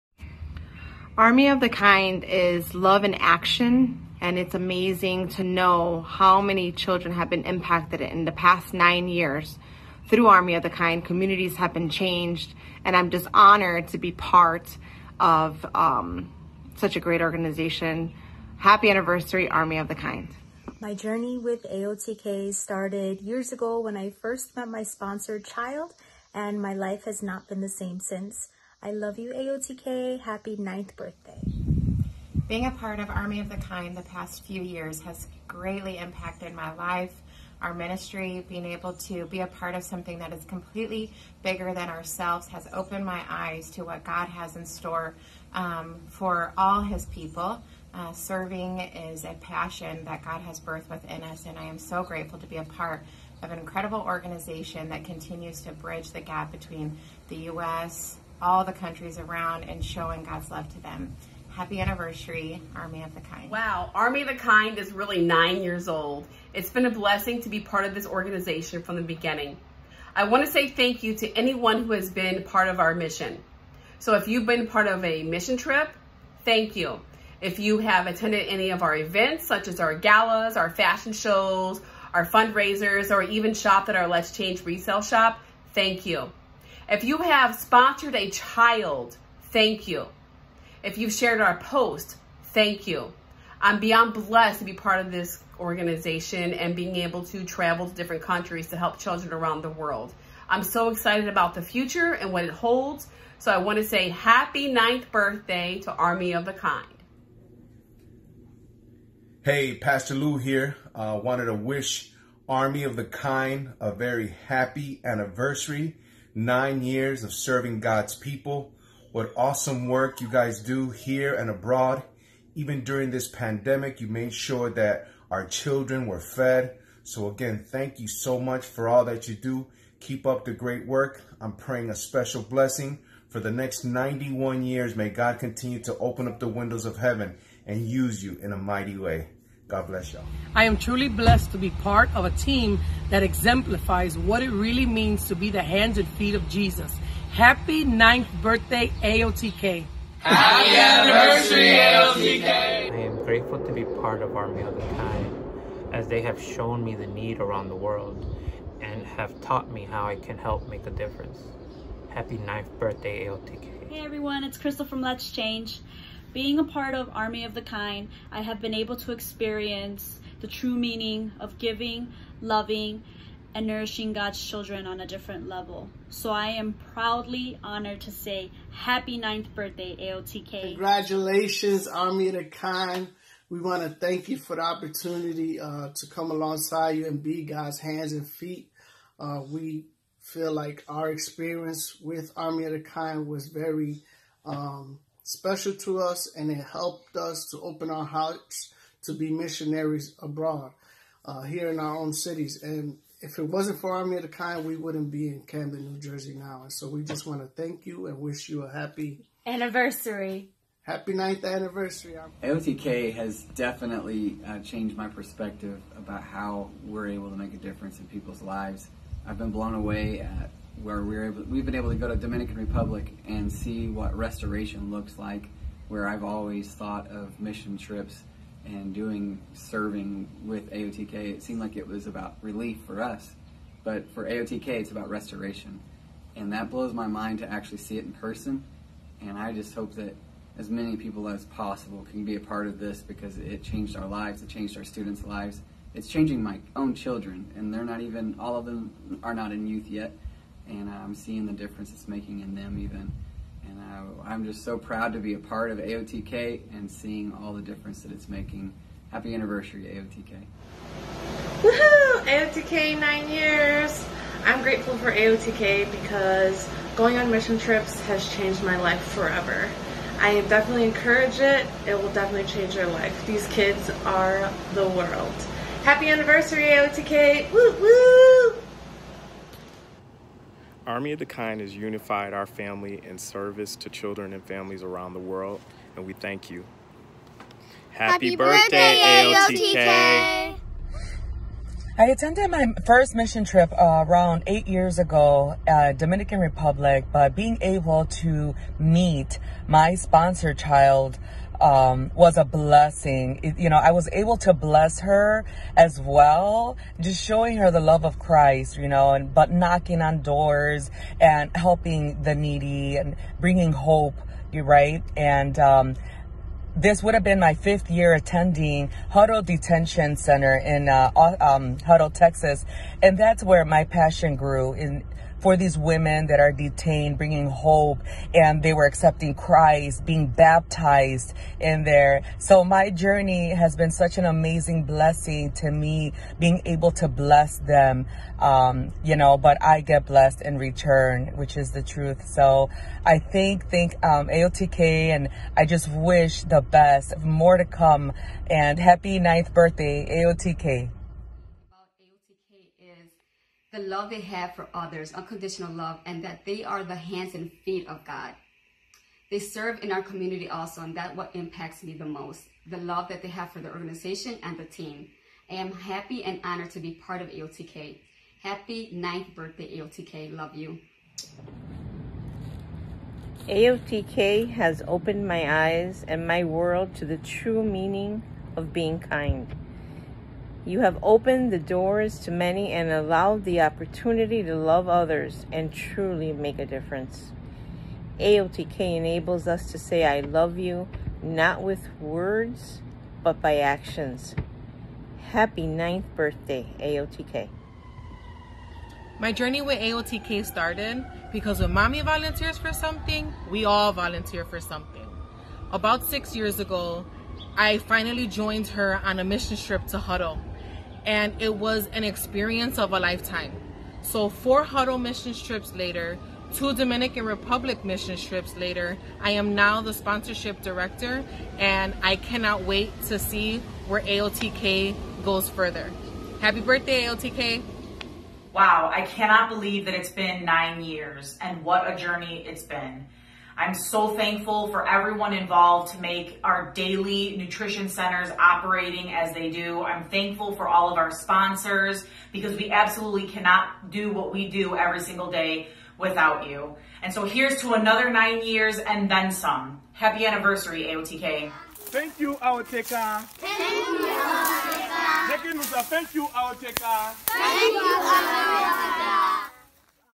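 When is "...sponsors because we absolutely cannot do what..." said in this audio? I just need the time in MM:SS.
07:21.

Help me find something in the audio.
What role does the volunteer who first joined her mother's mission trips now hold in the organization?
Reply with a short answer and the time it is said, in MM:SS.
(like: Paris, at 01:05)
Sponsorship director, at 06:59.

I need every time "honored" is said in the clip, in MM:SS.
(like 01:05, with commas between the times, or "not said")
00:13, 02:57, 06:06.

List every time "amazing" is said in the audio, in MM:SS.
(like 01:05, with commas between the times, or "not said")
00:04, 05:34.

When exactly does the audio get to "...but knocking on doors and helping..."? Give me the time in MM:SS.
05:09.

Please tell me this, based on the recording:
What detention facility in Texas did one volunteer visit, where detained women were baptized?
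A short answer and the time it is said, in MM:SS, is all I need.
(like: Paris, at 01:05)
Hutto Detention Center, at 05:19.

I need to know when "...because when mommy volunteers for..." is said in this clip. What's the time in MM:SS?
06:41.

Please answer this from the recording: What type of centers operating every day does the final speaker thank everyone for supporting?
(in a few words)
Daily nutrition centers.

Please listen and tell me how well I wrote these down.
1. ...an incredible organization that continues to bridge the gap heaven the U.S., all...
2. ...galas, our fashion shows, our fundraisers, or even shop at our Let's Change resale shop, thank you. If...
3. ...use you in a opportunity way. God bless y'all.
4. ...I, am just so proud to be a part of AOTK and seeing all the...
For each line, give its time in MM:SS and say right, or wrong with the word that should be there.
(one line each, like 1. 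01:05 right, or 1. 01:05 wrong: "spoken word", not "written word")
1. 00:53 wrong: "between", not "heaven"
2. 01:19 right
3. 02:17 wrong: "mighty", not "opportunity"
4. 04:14 right.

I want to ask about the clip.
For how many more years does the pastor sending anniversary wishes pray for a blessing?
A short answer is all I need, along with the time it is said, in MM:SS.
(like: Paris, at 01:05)
91, at 02:13.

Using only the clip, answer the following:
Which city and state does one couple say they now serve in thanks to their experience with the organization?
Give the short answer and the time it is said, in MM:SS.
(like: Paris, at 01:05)
Camden, New Jersey, at 03:25.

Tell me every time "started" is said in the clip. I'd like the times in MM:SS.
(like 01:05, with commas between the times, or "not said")
00:22, 06:40.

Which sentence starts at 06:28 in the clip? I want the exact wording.
AOTK enables us to say, I love you, not with words, but by actions.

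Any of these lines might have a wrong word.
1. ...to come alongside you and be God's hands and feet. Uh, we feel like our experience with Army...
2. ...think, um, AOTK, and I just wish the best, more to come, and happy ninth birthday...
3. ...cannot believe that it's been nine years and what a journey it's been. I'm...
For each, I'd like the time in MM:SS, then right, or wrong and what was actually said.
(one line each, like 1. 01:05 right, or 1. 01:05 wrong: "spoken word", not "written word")
1. 03:05 right
2. 05:43 right
3. 07:09 right.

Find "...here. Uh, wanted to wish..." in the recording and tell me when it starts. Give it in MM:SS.
01:50.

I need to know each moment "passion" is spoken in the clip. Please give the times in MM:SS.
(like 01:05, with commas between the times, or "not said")
00:49, 05:23.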